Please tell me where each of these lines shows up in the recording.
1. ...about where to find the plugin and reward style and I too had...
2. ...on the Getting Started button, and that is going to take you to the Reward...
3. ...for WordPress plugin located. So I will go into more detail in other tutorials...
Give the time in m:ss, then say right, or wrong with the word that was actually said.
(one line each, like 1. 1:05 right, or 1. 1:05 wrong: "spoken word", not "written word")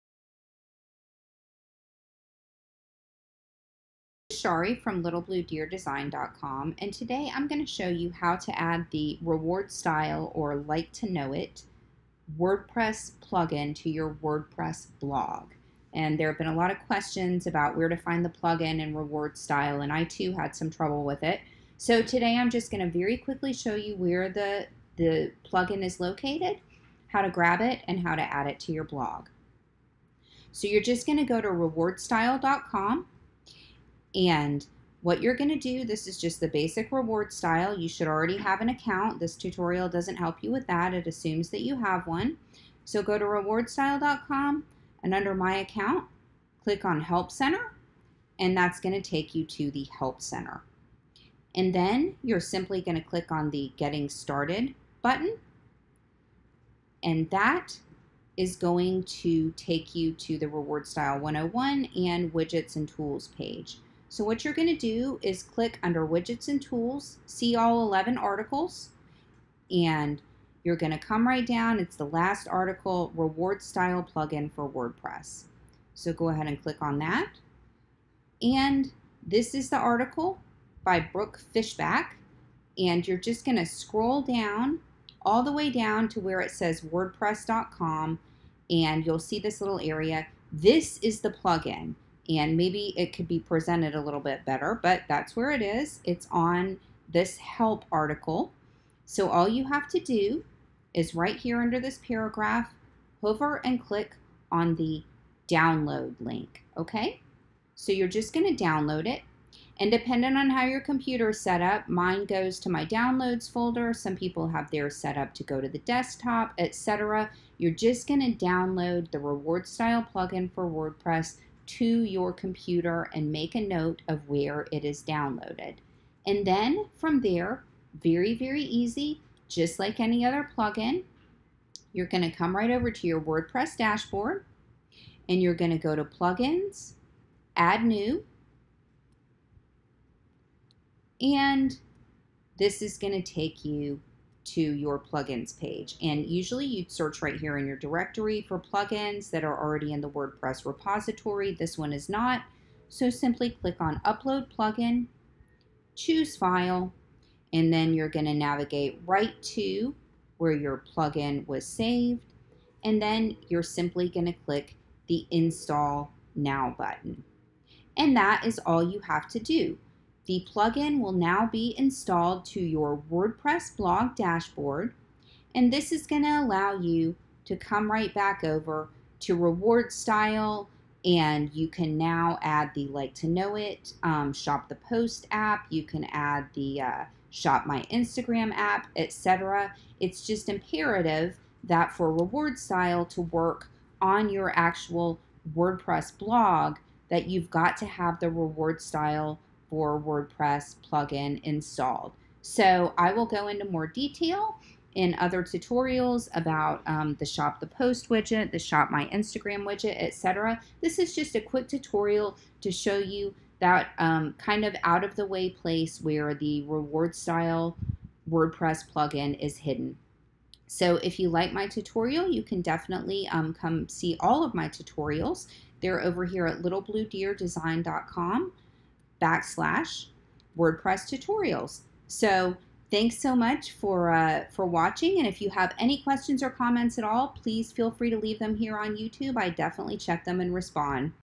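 1. 0:17 right
2. 0:53 right
3. 3:19 wrong: "installed", not "located".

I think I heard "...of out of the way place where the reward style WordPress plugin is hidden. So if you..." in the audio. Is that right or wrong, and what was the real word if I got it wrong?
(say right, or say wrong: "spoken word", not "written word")
right.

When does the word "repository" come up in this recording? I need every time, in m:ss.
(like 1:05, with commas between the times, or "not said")
2:30.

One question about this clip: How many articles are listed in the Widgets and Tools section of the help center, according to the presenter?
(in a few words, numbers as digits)
11.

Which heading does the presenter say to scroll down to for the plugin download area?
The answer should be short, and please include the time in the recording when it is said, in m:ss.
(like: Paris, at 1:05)
WordPress.com, at 1:26.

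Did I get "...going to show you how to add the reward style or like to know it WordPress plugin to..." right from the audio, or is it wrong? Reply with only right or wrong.
right.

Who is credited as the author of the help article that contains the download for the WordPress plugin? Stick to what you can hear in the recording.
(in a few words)
Brooke Fishback.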